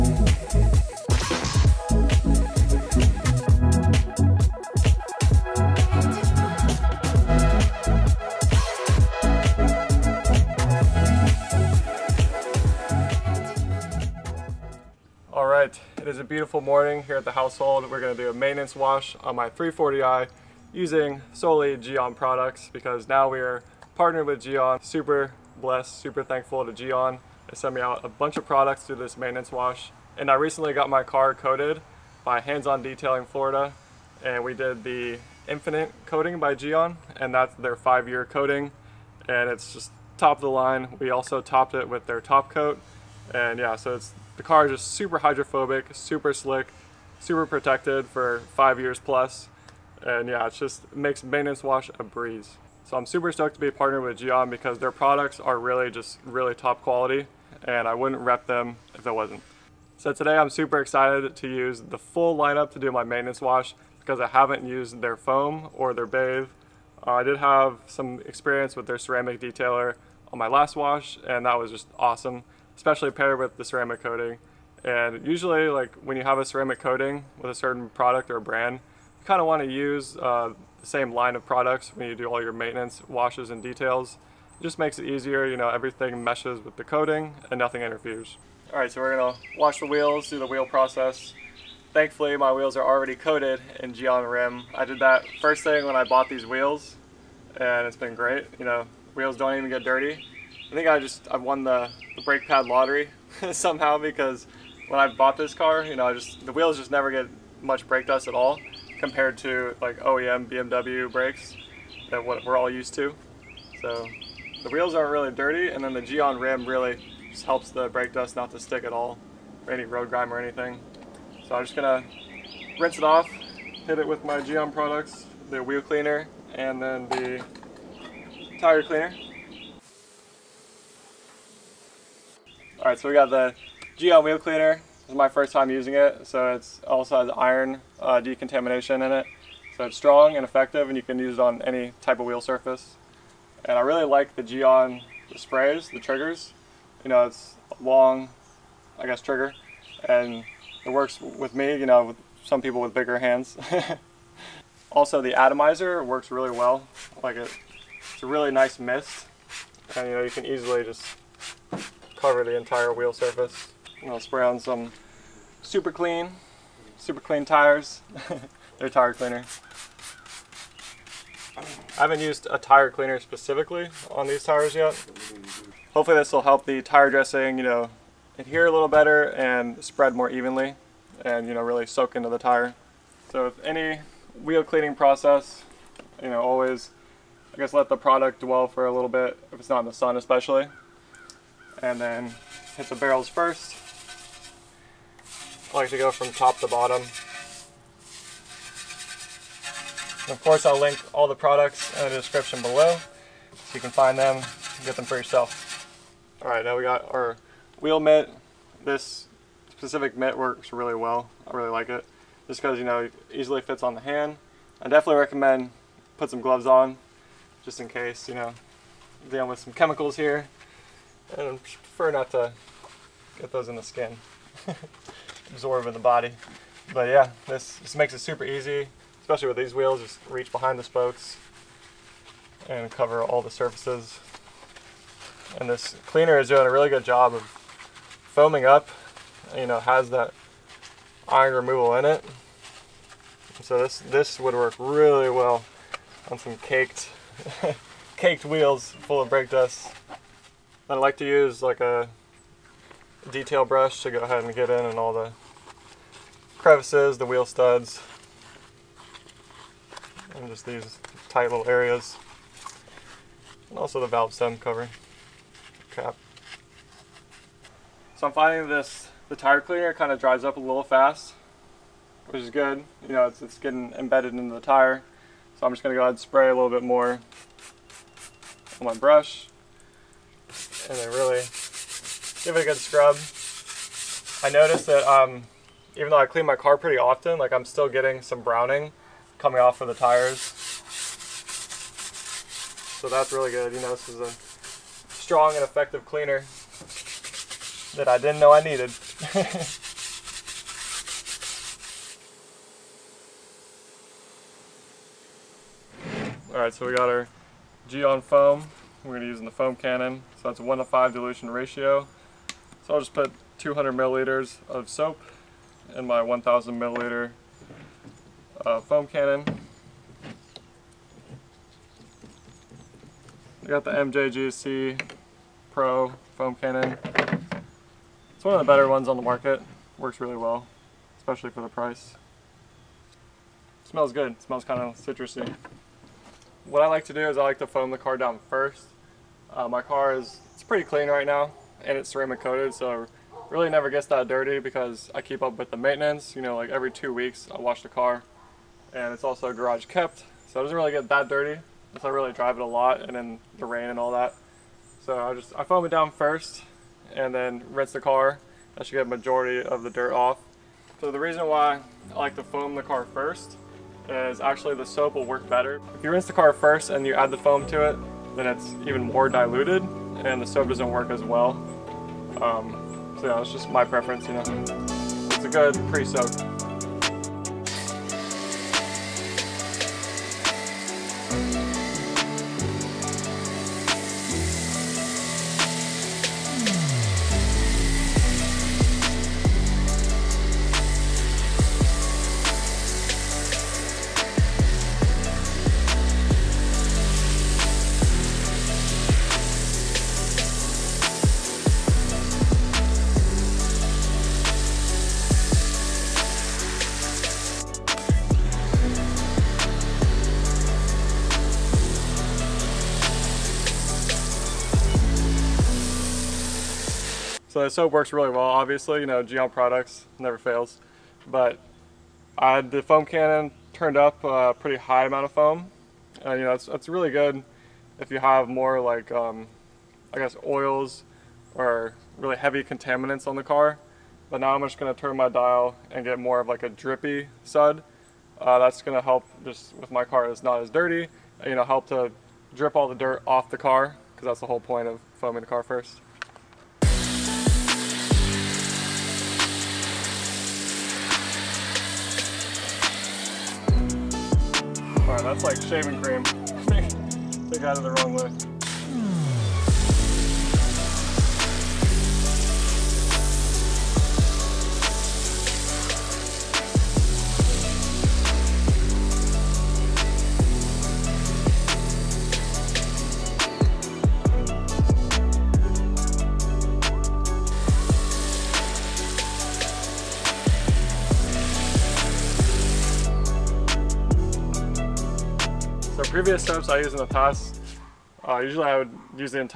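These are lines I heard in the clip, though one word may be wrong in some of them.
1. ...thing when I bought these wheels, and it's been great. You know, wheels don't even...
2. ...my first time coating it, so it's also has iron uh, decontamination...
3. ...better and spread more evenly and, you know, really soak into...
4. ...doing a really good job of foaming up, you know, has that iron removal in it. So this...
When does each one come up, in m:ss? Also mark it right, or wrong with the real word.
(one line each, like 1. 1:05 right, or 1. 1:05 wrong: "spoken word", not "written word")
1. 1:35 right
2. 2:15 wrong: "using", not "coating"
3. 2:58 right
4. 3:56 right.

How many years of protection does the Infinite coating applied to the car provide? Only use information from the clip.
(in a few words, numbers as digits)
5.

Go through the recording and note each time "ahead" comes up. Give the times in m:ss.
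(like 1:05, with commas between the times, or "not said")
4:14, 4:36.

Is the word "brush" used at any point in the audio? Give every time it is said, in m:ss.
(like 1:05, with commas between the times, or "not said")
4:13, 4:38.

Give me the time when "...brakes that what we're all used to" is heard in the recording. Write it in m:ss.
1:51.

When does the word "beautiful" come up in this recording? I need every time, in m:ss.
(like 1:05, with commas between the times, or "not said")
0:16.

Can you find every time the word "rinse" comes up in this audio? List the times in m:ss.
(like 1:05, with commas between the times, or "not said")
2:02, 5:57, 6:06.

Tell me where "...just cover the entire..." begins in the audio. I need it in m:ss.
2:40.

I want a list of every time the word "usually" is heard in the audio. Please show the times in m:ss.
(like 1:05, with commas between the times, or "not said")
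1:15, 8:08.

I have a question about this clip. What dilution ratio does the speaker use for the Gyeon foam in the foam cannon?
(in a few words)
1 to 5.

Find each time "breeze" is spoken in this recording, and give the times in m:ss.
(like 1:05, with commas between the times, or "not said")
0:52.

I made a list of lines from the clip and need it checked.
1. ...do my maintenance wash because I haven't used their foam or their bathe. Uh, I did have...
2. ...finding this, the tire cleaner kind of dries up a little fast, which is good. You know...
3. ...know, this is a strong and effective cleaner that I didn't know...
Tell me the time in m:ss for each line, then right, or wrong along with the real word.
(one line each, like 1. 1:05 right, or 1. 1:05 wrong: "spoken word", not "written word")
1. 1:02 right
2. 4:28 right
3. 4:53 right.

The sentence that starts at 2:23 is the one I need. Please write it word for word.
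And I really like the Gyeon the sprays, the triggers.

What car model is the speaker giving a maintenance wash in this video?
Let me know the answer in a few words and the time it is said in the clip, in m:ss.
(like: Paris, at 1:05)
340i, at 0:19.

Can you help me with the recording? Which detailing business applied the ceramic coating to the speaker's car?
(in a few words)
Hands On Detailing Florida.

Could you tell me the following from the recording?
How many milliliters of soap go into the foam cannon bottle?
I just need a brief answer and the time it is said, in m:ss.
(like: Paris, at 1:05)
200, at 5:13.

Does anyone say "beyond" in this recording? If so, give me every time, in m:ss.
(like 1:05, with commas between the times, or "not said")
not said.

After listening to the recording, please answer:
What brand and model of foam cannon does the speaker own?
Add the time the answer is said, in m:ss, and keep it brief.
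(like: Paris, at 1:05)
MJJC Pro, at 5:23.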